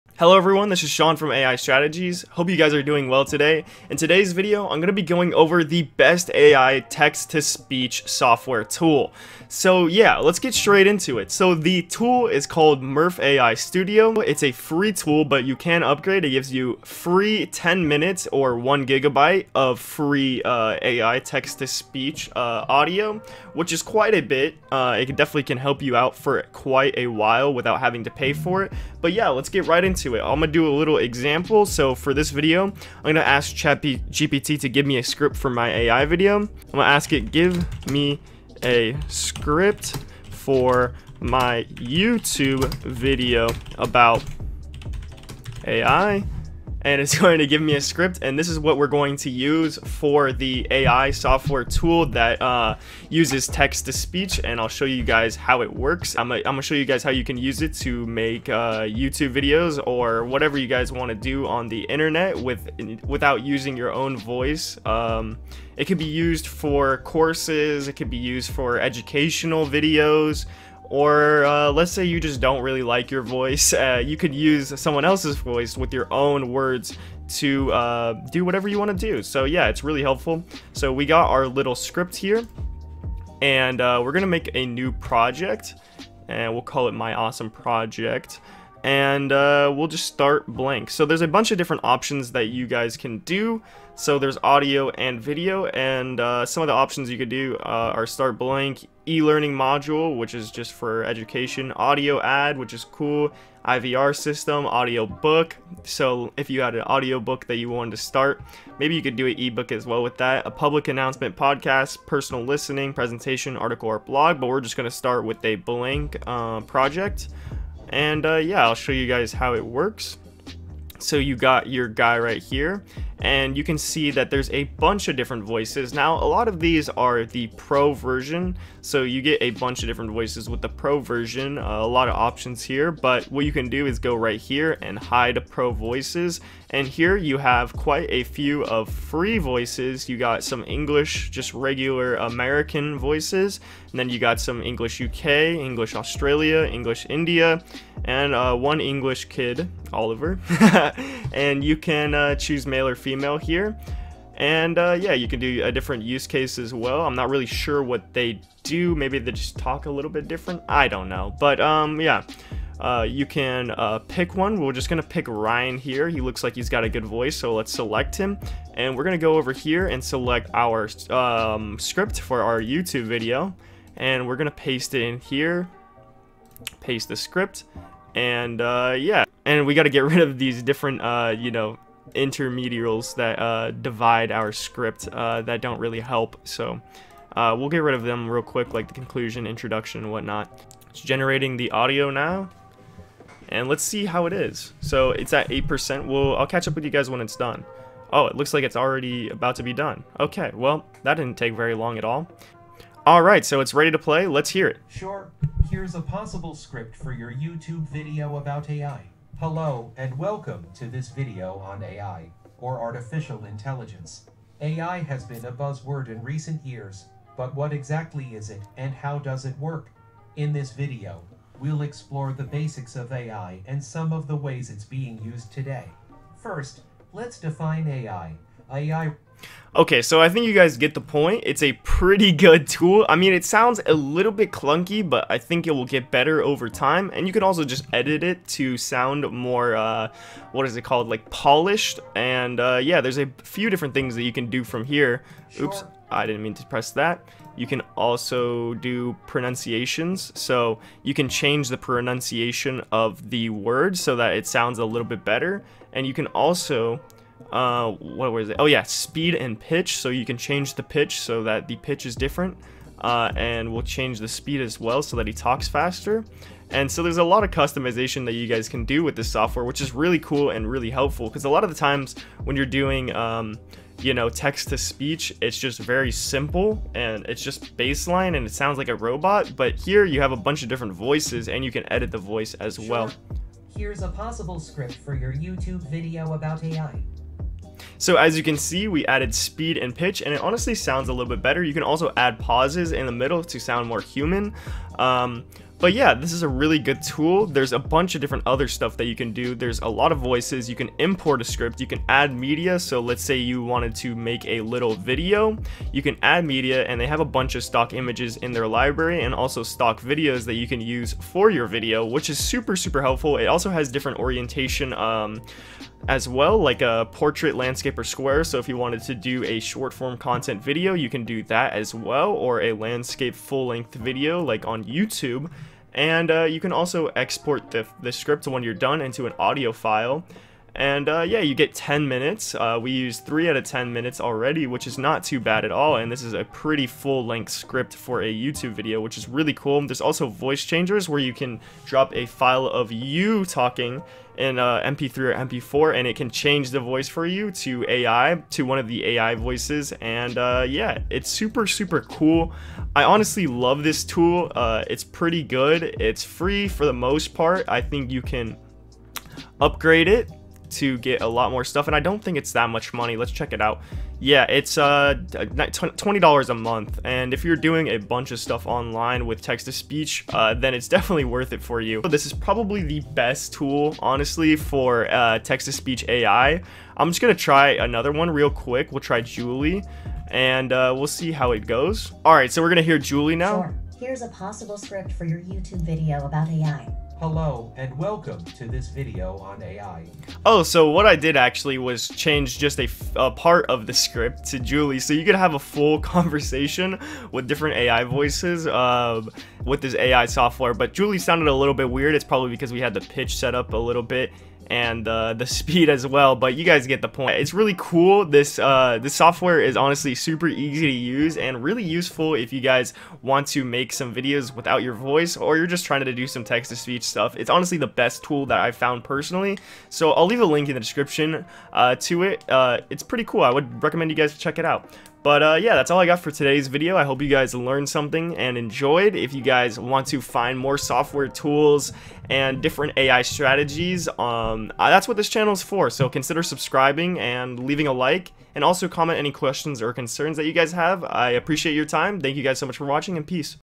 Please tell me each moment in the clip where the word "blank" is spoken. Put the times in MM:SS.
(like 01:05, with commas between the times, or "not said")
01:30, 01:38, 01:55.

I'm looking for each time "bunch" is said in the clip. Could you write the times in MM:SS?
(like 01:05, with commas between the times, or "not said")
01:31, 02:04, 02:09, 04:40, 04:57, 05:07, 06:07.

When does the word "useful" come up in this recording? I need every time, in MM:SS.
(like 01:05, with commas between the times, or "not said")
06:51.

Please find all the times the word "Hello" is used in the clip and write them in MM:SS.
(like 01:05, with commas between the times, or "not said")
00:00, 03:29, 06:27.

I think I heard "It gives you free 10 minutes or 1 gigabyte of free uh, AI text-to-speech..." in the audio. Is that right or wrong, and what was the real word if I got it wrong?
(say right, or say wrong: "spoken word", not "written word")
right.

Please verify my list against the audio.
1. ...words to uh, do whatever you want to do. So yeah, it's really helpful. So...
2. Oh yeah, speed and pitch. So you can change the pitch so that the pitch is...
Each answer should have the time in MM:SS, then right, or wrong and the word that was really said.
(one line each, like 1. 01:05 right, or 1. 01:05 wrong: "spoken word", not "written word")
1. 01:16 right
2. 04:18 right.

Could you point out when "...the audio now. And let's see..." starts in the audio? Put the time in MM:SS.
03:11.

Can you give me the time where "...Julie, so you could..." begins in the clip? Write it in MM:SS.
06:34.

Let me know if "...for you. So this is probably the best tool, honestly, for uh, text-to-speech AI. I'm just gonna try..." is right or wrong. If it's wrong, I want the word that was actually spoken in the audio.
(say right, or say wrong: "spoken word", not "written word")
right.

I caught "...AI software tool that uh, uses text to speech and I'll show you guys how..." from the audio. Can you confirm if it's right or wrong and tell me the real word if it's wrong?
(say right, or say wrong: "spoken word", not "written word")
right.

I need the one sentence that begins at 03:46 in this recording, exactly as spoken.
First, let's define AI, Okay, so I think you guys get the point.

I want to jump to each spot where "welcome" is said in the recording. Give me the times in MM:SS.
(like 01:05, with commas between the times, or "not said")
03:30, 06:27.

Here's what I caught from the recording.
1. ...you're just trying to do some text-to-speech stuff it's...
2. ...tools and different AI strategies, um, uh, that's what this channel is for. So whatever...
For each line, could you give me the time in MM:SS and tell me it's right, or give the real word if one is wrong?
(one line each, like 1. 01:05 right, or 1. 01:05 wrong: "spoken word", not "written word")
1. 06:55 right
2. 07:11 wrong: "consider", not "whatever".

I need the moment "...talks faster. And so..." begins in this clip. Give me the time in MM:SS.
04:25.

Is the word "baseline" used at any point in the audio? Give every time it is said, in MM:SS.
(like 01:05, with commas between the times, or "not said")
04:37.